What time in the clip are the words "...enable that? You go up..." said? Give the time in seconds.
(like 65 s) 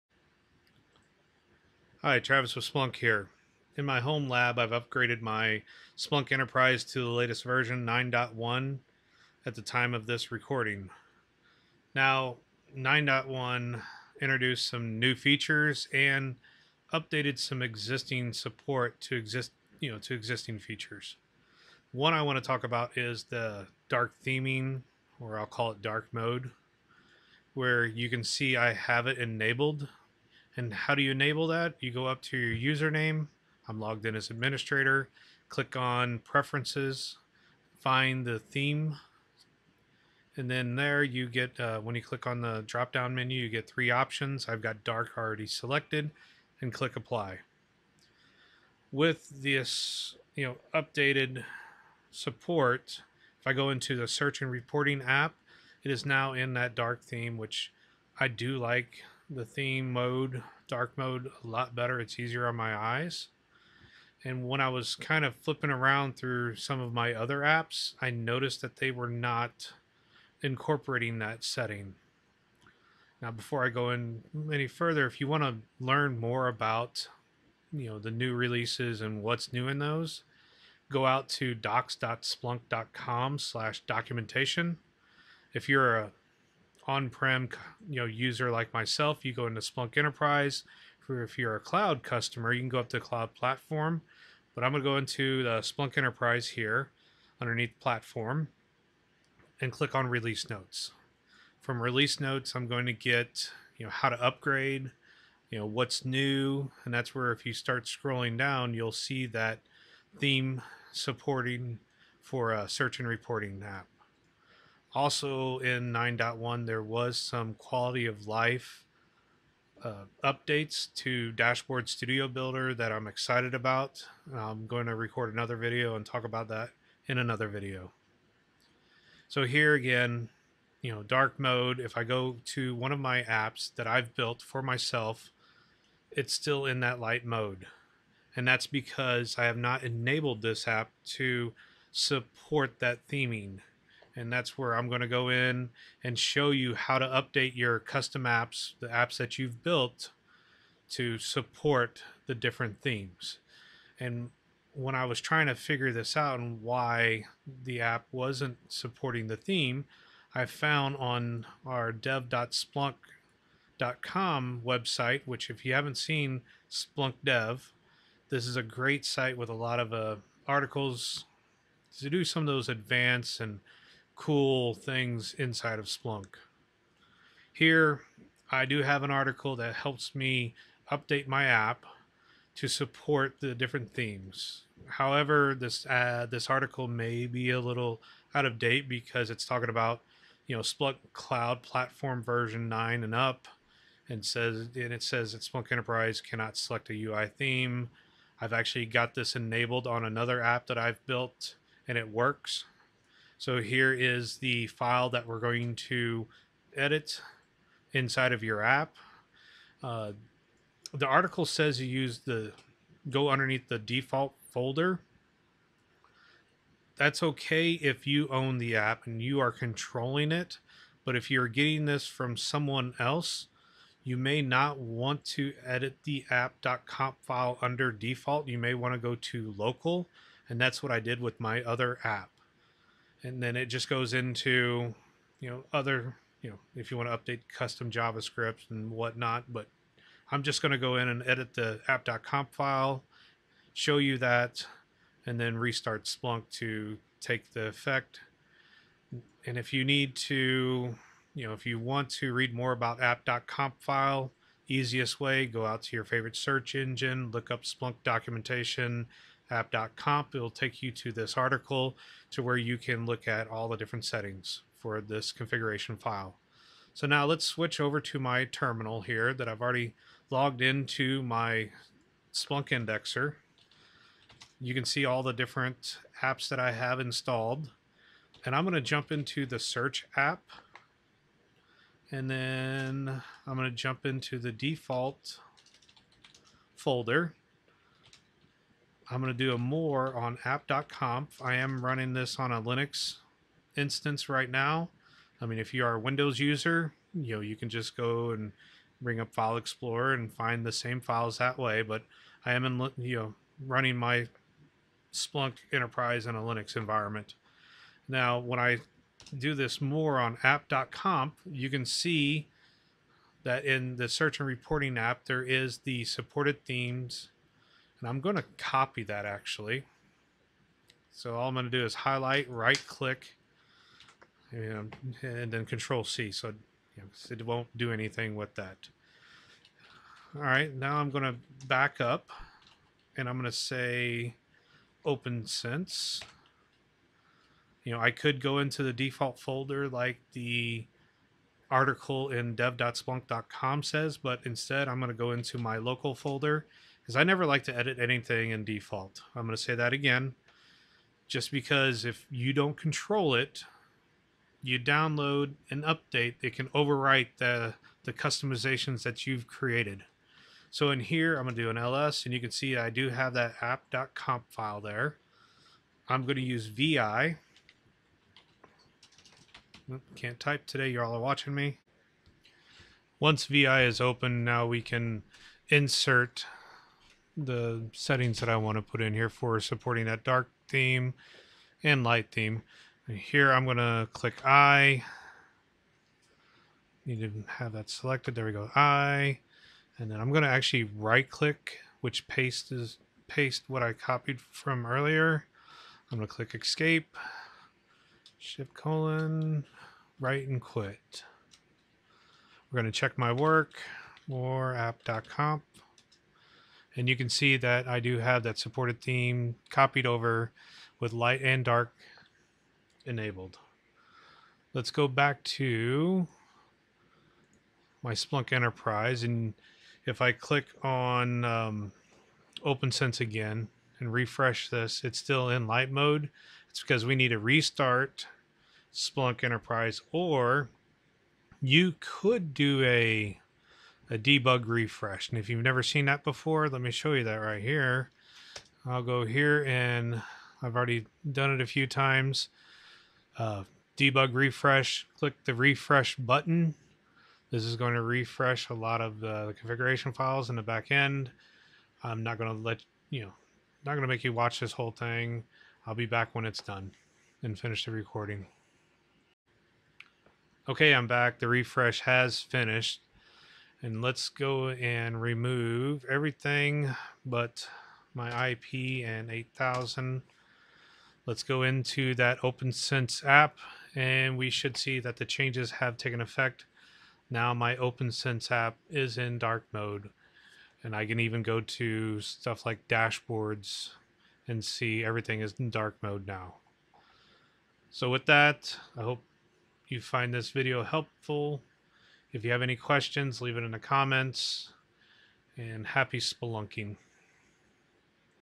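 31 s.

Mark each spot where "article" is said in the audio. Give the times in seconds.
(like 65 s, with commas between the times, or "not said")
170 s, 179 s, 186 s, 211 s, 261 s, 341 s.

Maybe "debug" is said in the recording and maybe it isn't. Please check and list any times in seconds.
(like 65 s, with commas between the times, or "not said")
434 s, 443 s.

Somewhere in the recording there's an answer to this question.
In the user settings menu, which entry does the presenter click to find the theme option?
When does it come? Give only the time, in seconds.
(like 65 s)
36 s.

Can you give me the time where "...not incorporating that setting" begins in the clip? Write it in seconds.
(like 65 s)
69 s.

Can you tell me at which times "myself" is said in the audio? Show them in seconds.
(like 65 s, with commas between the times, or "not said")
88 s, 134 s.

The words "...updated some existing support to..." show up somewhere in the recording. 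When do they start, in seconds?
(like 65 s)
16 s.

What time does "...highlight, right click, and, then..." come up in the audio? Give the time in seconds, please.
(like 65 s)
321 s.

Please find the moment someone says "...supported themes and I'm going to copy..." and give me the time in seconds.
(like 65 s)
316 s.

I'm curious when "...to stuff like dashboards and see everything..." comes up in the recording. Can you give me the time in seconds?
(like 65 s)
481 s.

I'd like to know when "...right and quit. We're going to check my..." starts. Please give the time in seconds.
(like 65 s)
400 s.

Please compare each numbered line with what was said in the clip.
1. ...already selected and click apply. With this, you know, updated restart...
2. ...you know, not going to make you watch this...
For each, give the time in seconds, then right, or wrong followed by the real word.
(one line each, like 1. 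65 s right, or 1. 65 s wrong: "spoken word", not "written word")
1. 45 s wrong: "support", not "restart"
2. 453 s right.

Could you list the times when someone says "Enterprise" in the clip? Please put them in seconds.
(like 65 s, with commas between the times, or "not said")
6 s, 89 s, 95 s, 195 s, 305 s, 418 s, 429 s.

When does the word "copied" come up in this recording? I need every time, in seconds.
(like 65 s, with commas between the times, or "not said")
393 s, 409 s.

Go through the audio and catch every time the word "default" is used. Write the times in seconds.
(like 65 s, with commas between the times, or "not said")
213 s, 227 s, 284 s, 338 s, 348 s.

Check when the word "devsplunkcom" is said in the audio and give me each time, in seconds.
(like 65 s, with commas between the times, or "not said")
161 s, 342 s.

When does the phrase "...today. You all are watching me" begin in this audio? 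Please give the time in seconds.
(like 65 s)
370 s.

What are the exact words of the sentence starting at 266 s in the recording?
So now let's switch over to my terminal here that I've already logged into my Splunk indexer.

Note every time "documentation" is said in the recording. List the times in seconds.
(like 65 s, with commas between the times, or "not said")
83 s, 258 s.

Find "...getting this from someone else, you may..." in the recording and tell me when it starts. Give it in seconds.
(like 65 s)
221 s.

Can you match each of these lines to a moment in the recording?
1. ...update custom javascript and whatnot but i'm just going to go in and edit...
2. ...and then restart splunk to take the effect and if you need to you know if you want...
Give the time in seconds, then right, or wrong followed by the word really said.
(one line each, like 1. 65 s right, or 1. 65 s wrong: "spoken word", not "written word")
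1. 237 s right
2. 245 s right.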